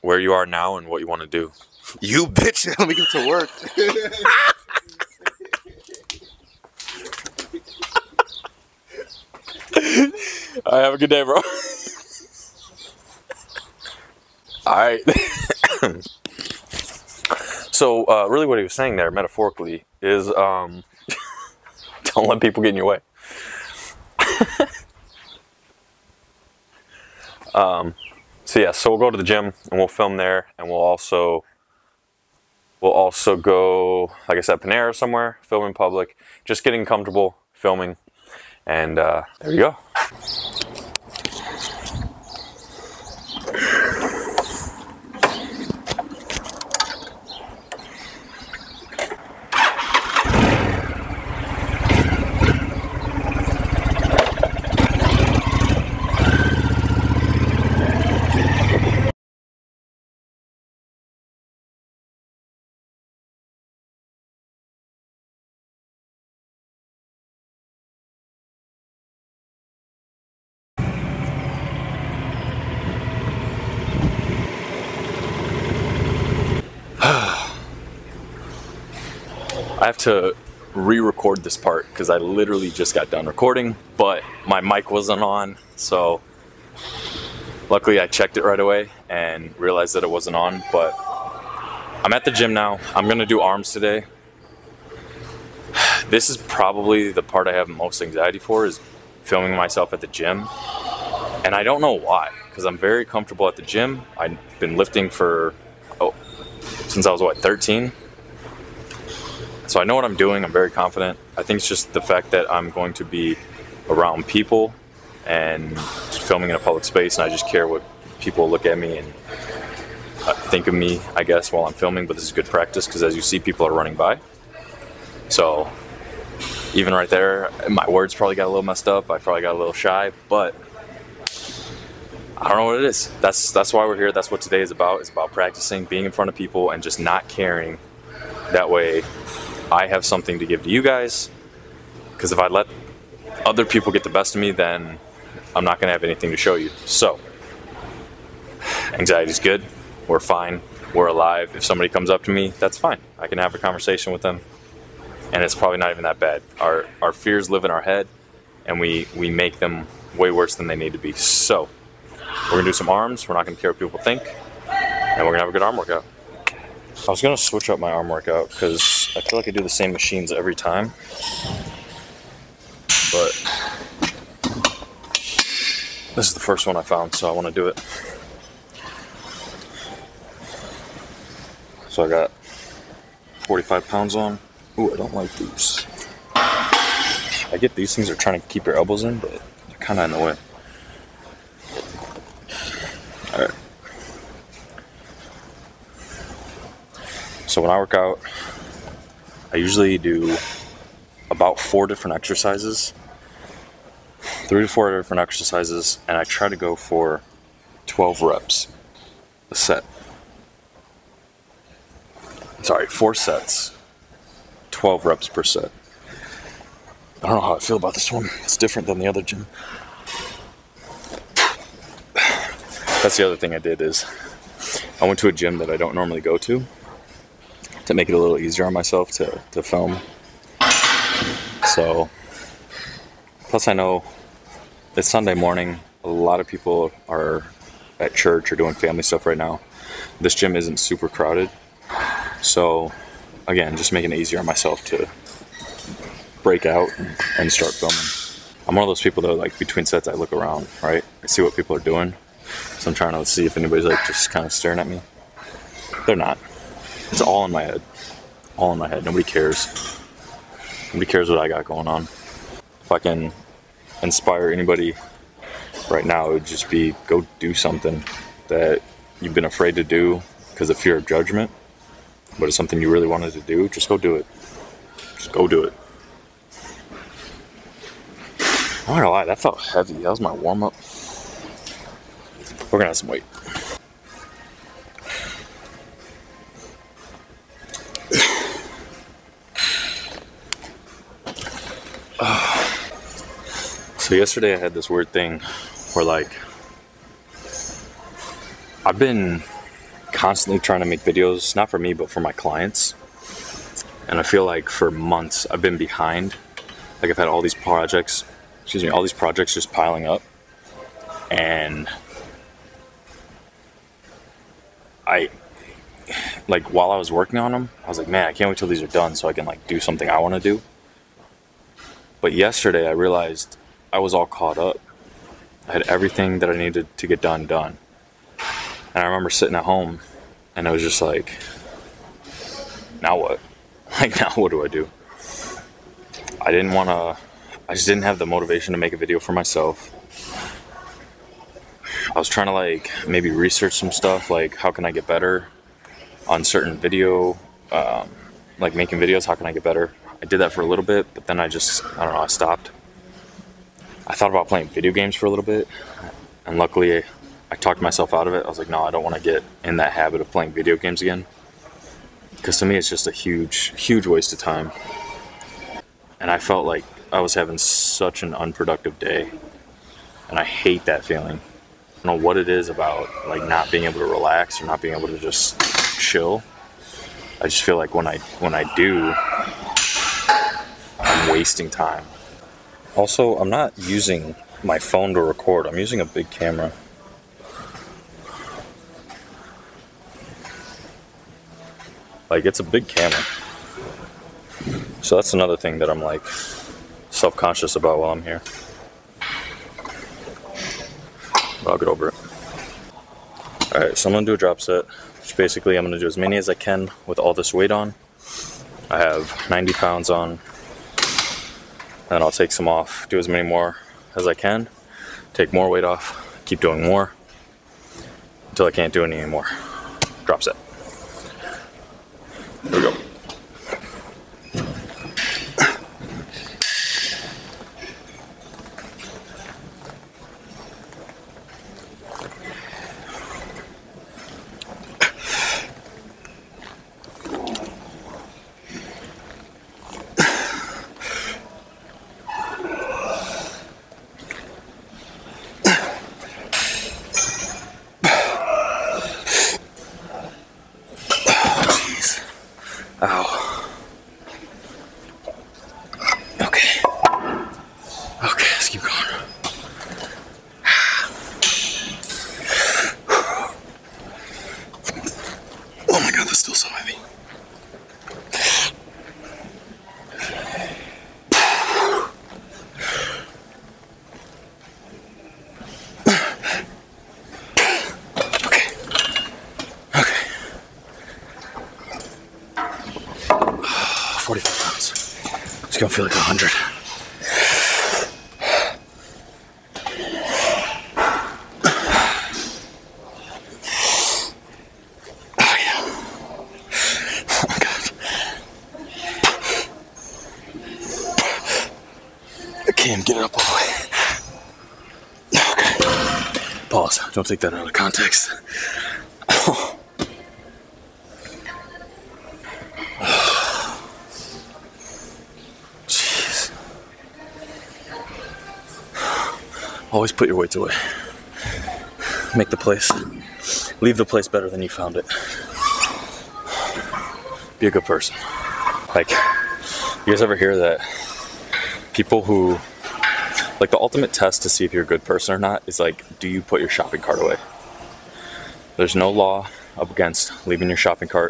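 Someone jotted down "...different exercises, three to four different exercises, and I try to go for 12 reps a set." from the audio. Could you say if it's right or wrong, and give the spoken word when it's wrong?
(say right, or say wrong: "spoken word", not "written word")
right.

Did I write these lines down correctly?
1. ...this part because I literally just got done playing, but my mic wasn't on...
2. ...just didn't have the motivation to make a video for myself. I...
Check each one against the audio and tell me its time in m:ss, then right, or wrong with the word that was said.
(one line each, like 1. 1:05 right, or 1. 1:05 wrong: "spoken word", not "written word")
1. 1:21 wrong: "recording", not "playing"
2. 5:37 right.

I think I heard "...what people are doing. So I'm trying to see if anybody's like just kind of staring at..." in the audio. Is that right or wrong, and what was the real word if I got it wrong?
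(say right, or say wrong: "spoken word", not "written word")
right.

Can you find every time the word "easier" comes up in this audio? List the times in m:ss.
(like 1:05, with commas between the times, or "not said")
3:48, 4:04.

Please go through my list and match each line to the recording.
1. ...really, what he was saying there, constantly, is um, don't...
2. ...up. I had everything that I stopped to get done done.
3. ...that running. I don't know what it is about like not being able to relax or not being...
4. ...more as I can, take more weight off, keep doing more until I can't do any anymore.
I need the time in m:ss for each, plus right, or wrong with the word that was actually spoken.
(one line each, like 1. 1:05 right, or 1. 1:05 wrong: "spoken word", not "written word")
1. 0:18 wrong: "metaphorically", not "constantly"
2. 5:24 wrong: "needed", not "stopped"
3. 6:10 wrong: "feeling", not "running"
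4. 6:53 right.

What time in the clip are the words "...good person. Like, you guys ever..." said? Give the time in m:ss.
8:47.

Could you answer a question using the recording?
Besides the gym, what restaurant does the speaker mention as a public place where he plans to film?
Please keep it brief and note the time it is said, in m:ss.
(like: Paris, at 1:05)
Panera, at 0:34.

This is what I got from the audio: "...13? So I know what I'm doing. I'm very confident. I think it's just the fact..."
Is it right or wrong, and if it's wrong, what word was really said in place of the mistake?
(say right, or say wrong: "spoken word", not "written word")
right.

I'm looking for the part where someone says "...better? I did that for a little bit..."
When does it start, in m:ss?
5:49.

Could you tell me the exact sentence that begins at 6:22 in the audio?
Also, I'm not using my phone to record.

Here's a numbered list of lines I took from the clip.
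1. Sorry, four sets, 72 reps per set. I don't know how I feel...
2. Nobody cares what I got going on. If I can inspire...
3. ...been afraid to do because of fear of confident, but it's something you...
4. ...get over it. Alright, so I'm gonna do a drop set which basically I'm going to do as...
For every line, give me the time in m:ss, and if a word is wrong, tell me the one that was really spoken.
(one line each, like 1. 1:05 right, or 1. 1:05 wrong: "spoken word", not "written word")
1. 3:32 wrong: "12", not "72"
2. 4:20 right
3. 4:29 wrong: "judgment", not "confident"
4. 6:41 right.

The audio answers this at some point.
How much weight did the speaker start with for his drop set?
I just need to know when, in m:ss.
6:49.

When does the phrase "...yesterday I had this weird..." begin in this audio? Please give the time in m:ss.
4:54.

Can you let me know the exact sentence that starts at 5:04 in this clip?
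And I feel like for months I've been behind.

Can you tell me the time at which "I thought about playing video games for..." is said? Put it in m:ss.
5:54.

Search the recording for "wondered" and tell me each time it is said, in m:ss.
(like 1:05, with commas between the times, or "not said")
not said.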